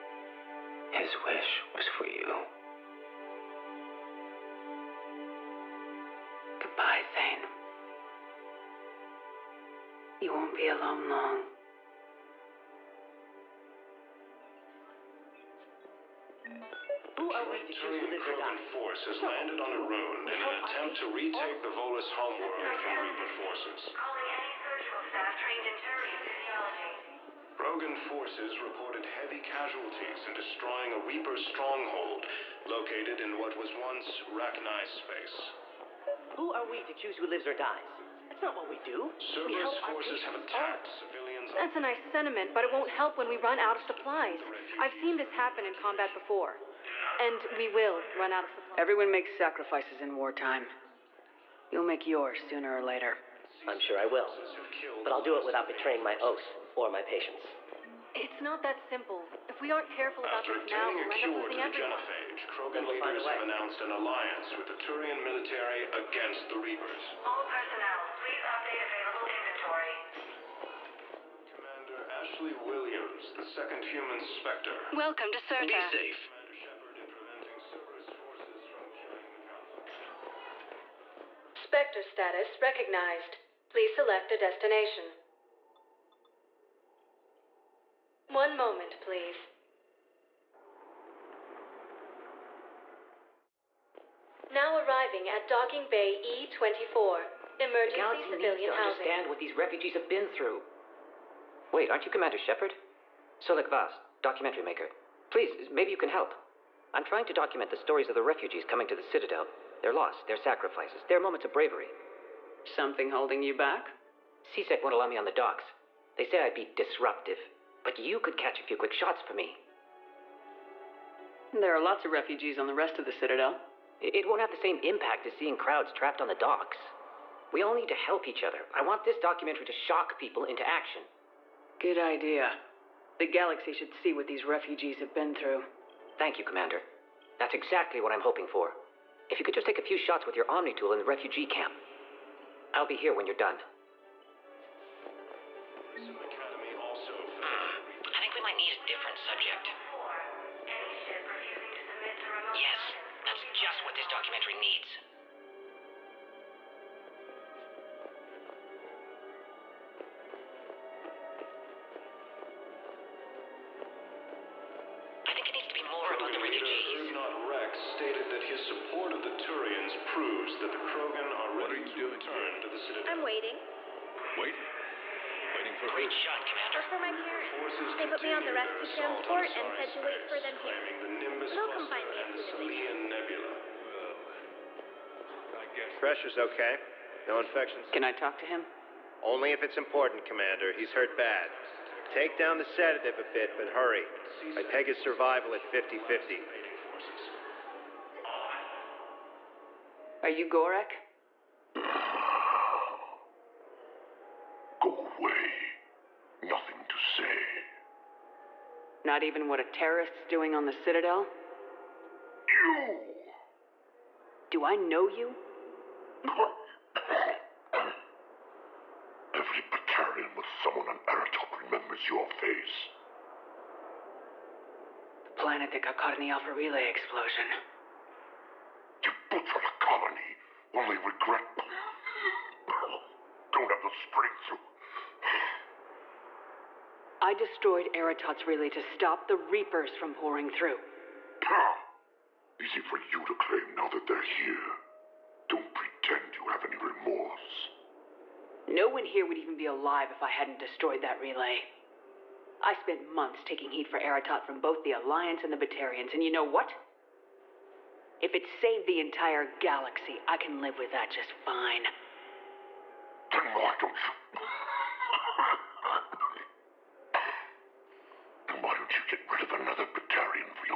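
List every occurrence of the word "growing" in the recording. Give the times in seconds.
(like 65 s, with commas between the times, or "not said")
not said.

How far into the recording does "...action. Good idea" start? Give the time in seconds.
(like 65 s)
130 s.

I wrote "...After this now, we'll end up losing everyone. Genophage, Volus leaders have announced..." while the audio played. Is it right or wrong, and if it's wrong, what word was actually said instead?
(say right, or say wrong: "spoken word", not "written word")
wrong: "Krogan", not "Volus".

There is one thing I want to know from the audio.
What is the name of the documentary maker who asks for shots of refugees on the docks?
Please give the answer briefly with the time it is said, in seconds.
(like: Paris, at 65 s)
Solik Vas, at 103 s.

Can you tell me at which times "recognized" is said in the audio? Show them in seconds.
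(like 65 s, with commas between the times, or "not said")
82 s.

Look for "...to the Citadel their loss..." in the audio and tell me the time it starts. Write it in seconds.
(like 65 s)
108 s.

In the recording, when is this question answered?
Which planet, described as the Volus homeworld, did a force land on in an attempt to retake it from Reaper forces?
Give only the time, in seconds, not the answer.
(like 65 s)
19 s.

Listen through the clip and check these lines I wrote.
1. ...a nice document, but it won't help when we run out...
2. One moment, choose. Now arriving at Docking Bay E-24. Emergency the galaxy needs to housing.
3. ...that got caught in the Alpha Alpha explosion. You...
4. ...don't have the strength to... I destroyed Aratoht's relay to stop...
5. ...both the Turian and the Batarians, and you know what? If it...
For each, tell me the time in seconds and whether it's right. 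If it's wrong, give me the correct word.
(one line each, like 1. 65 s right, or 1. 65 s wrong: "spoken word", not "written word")
1. 41 s wrong: "sentiment", not "document"
2. 88 s wrong: "please", not "choose"
3. 225 s wrong: "Relay", not "Alpha"
4. 233 s right
5. 254 s wrong: "Alliance", not "Turian".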